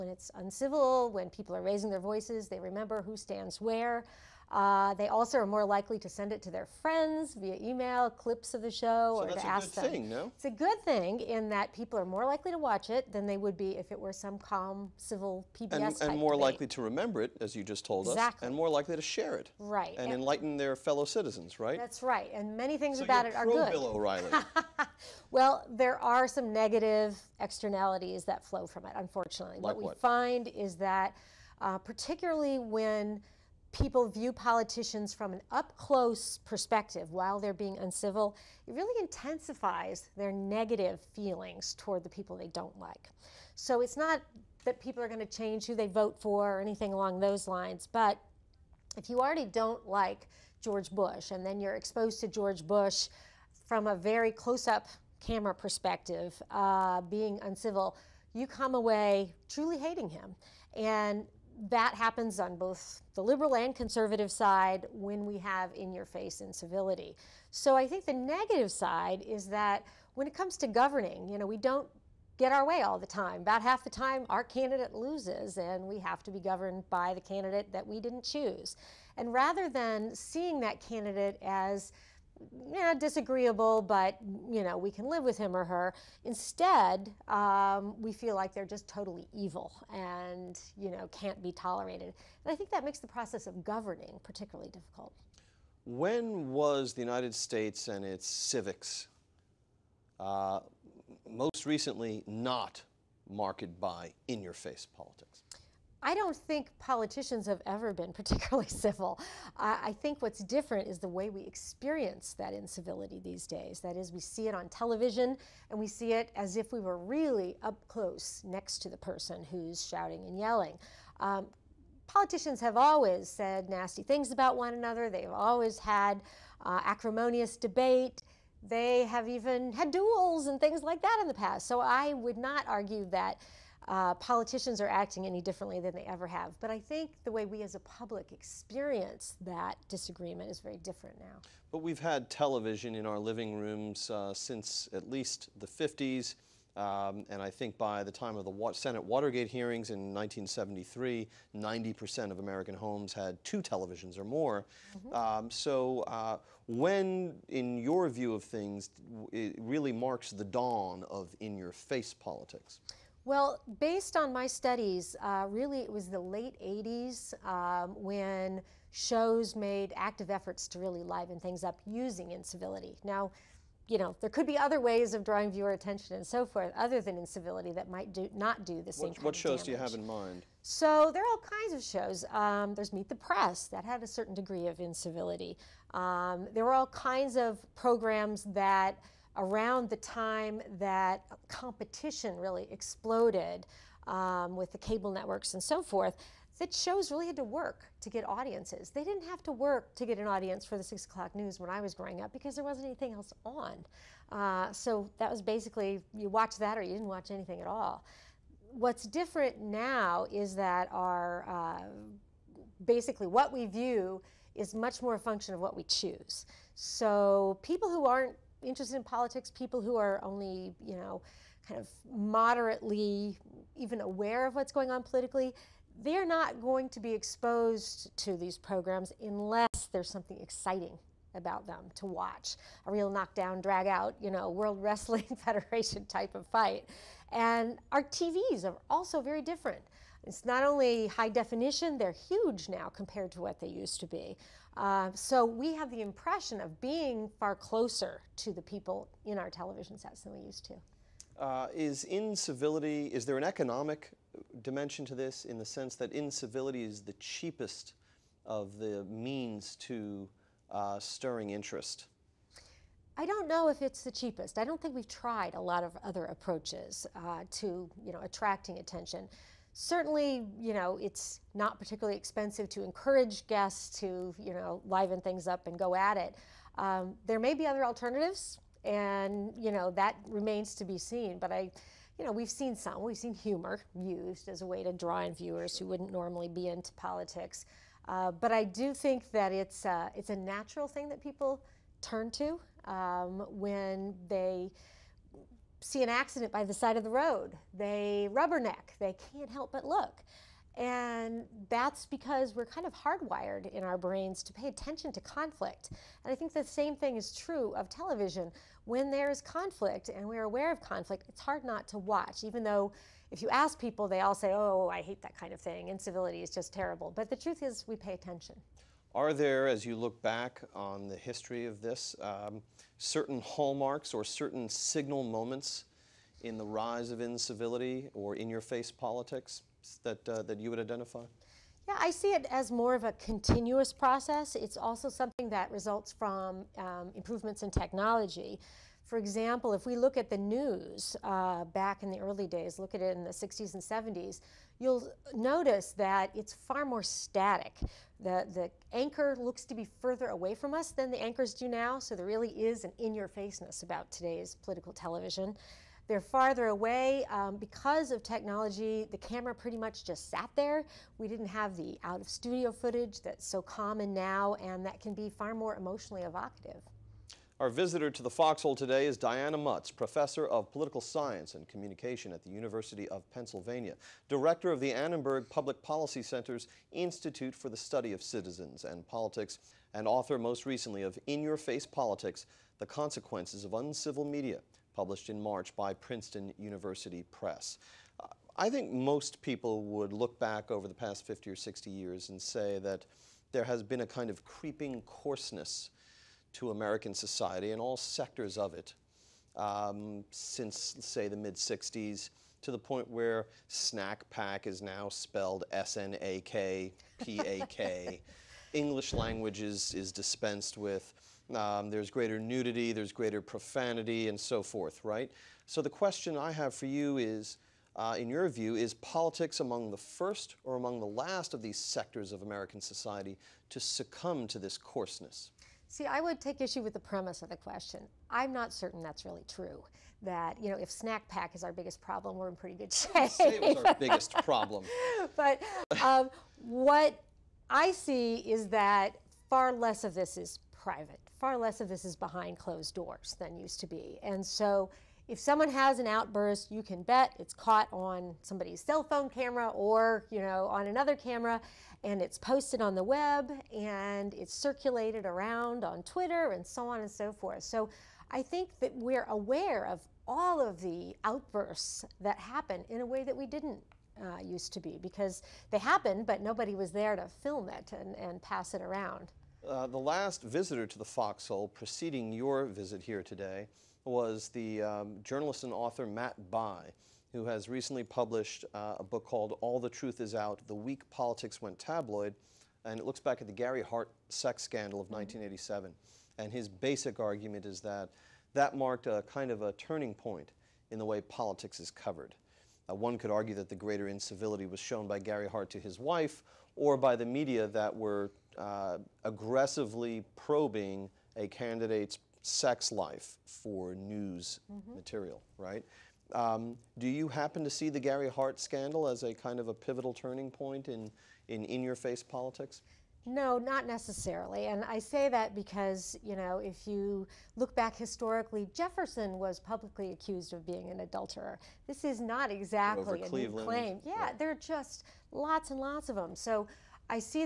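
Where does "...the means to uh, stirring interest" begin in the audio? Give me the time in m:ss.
4:18.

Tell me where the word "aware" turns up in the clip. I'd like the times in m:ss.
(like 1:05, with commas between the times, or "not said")
3:44, 5:10, 7:39.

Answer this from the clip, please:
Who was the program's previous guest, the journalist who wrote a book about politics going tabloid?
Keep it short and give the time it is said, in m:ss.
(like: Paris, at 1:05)
Matt Bai, at 7:56.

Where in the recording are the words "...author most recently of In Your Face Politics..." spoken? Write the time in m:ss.
6:20.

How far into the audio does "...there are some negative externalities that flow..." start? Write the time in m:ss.
0:25.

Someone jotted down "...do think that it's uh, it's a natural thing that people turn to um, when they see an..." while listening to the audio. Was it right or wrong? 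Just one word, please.
right.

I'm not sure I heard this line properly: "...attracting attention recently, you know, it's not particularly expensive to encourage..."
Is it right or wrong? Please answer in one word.
wrong.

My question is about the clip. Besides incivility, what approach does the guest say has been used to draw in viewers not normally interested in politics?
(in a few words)
humor.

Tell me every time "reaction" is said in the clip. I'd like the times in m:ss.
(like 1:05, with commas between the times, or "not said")
not said.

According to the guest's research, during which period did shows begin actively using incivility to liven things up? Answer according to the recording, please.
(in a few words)
late 80s.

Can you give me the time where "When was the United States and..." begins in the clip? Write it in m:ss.
1:35.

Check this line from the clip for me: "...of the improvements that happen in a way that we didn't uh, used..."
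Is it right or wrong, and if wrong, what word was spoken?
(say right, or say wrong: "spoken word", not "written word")
wrong: "outbursts", not "improvements".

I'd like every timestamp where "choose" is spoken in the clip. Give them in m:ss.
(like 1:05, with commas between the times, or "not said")
1:18, 3:35.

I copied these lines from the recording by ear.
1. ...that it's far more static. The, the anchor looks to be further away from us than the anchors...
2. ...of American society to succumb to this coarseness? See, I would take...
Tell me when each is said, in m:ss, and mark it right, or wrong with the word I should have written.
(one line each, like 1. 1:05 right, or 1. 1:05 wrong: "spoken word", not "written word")
1. 5:45 right
2. 7:02 right.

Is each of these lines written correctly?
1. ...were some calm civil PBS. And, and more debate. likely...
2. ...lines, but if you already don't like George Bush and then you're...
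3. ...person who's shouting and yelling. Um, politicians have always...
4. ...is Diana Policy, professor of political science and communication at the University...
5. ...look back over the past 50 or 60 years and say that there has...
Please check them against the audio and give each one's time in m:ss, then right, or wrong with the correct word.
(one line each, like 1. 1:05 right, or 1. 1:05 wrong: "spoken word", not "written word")
1. 0:13 right
2. 0:47 right
3. 1:58 right
4. 6:09 wrong: "Mutz", not "Policy"
5. 6:30 right.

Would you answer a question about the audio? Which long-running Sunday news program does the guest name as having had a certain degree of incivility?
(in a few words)
Meet the Press.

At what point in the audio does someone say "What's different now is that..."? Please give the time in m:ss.
3:28.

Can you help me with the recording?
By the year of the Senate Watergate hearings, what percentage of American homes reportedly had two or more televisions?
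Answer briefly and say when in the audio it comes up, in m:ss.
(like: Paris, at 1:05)
90%, at 2:31.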